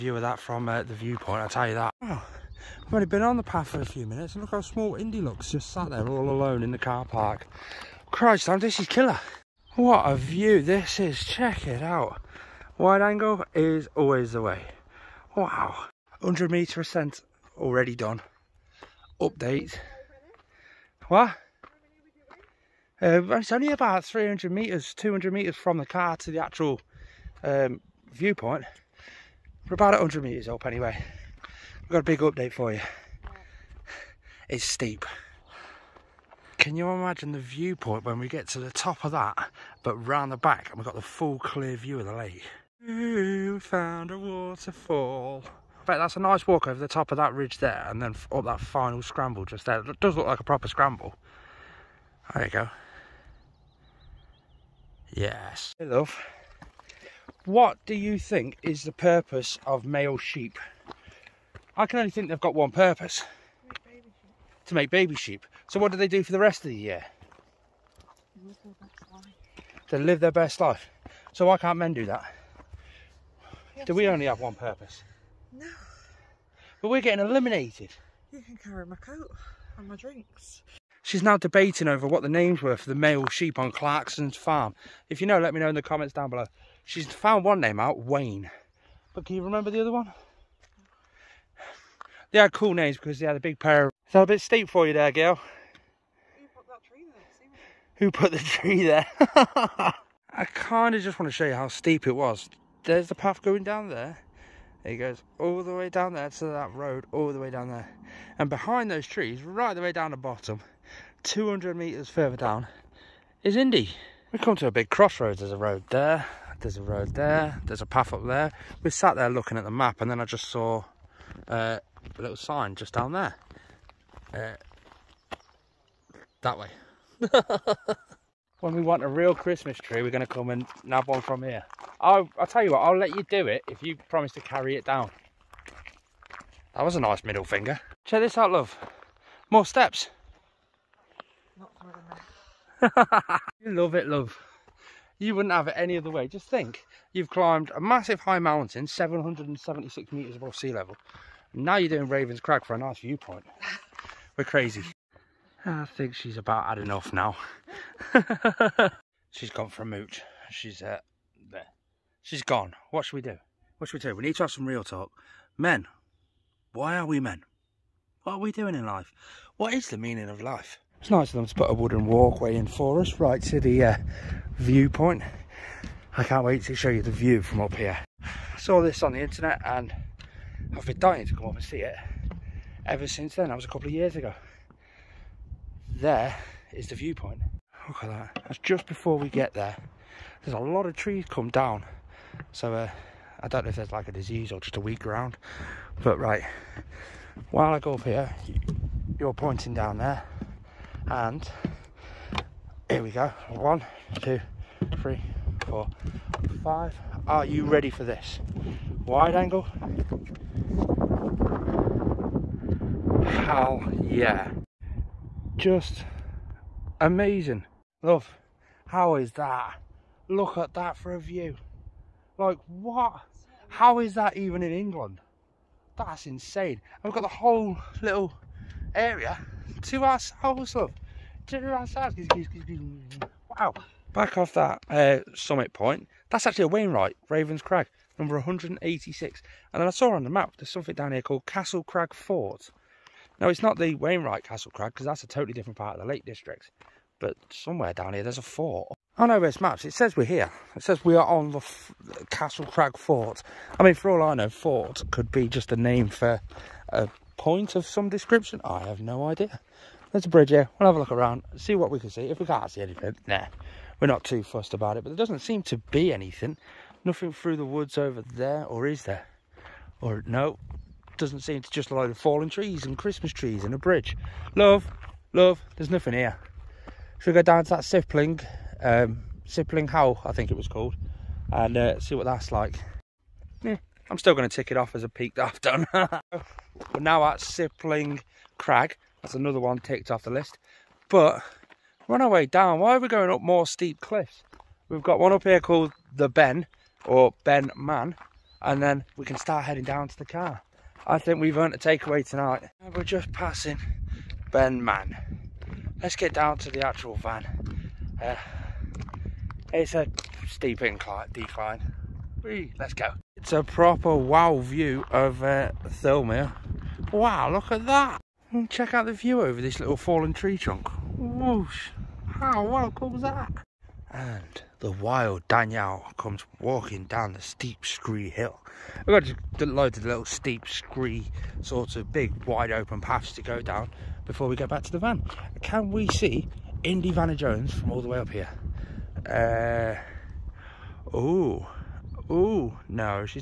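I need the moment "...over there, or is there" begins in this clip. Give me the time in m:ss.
4:27.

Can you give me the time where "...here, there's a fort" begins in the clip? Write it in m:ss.
4:08.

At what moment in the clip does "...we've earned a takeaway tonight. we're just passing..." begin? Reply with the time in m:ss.
5:01.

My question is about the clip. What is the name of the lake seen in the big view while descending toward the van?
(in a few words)
Thirlmere.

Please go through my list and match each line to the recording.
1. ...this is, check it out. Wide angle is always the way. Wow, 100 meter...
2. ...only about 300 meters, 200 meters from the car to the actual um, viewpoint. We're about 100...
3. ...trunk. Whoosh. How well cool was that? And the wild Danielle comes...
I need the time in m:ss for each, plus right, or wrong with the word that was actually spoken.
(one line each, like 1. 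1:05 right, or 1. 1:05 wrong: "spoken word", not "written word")
1. 0:10 right
2. 0:23 right
3. 5:20 right.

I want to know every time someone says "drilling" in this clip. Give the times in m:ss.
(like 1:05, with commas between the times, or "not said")
not said.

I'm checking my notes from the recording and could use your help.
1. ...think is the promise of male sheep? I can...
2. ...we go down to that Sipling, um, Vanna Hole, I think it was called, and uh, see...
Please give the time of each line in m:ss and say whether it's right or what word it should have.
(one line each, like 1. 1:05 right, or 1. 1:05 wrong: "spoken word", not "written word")
1. 0:58 wrong: "purpose", not "promise"
2. 4:37 wrong: "Sipling", not "Vanna".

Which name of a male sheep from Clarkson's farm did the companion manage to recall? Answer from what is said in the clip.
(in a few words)
Wayne.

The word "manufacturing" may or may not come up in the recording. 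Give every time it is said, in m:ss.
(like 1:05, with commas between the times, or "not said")
not said.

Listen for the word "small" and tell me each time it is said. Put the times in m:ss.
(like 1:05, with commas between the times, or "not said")
0:04.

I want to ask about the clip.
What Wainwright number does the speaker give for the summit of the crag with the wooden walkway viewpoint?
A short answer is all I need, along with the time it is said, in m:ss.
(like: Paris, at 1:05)
186, at 3:58.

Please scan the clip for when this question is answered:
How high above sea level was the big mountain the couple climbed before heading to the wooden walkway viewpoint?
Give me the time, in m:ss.
2:28.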